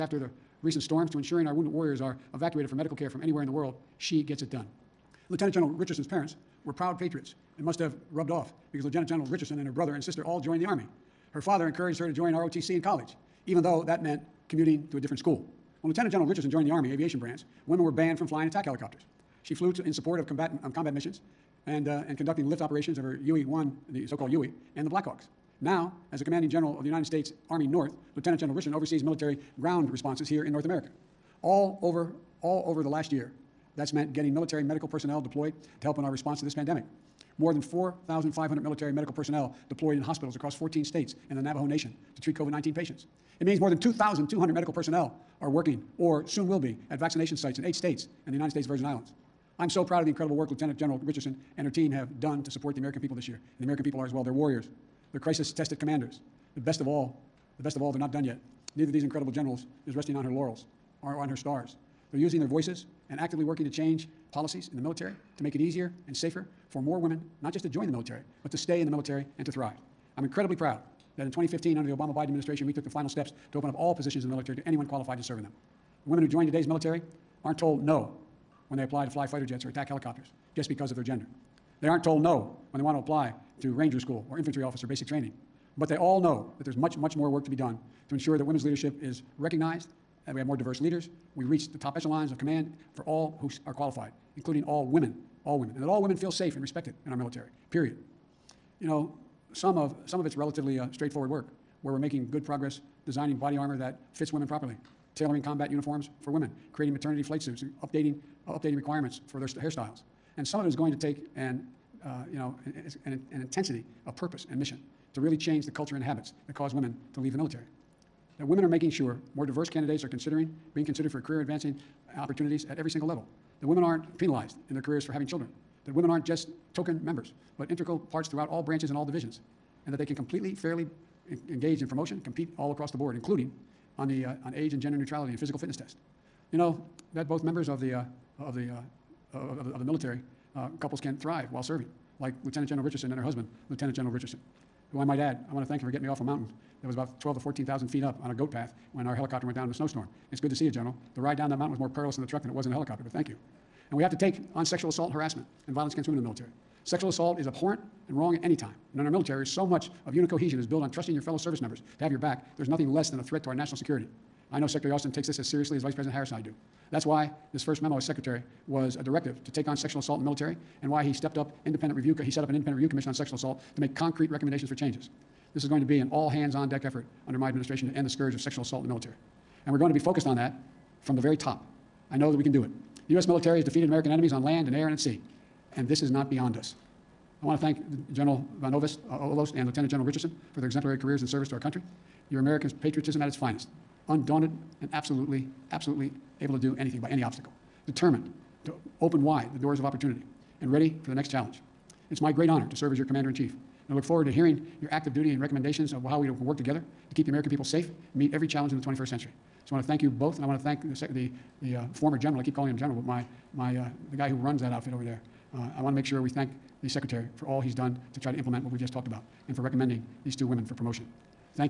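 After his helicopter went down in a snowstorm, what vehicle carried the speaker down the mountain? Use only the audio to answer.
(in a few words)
truck.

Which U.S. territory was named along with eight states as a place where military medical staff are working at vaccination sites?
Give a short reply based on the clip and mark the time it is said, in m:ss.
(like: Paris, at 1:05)
United States Virgin Islands, at 0:48.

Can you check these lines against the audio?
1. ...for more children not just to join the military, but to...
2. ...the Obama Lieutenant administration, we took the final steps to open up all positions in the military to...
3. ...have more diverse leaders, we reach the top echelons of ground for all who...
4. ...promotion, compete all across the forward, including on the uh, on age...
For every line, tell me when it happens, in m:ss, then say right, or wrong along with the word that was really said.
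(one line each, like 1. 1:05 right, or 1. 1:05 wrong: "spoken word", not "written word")
1. 1:06 wrong: "women", not "children"
2. 1:11 wrong: "Biden", not "Lieutenant"
3. 1:30 wrong: "command", not "ground"
4. 2:11 wrong: "board", not "forward".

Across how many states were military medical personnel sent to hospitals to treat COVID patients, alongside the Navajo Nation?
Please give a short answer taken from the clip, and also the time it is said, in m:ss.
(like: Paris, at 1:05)
14, at 0:40.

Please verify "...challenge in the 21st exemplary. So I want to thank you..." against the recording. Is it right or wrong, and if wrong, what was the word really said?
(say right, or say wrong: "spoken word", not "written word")
wrong: "century", not "exemplary".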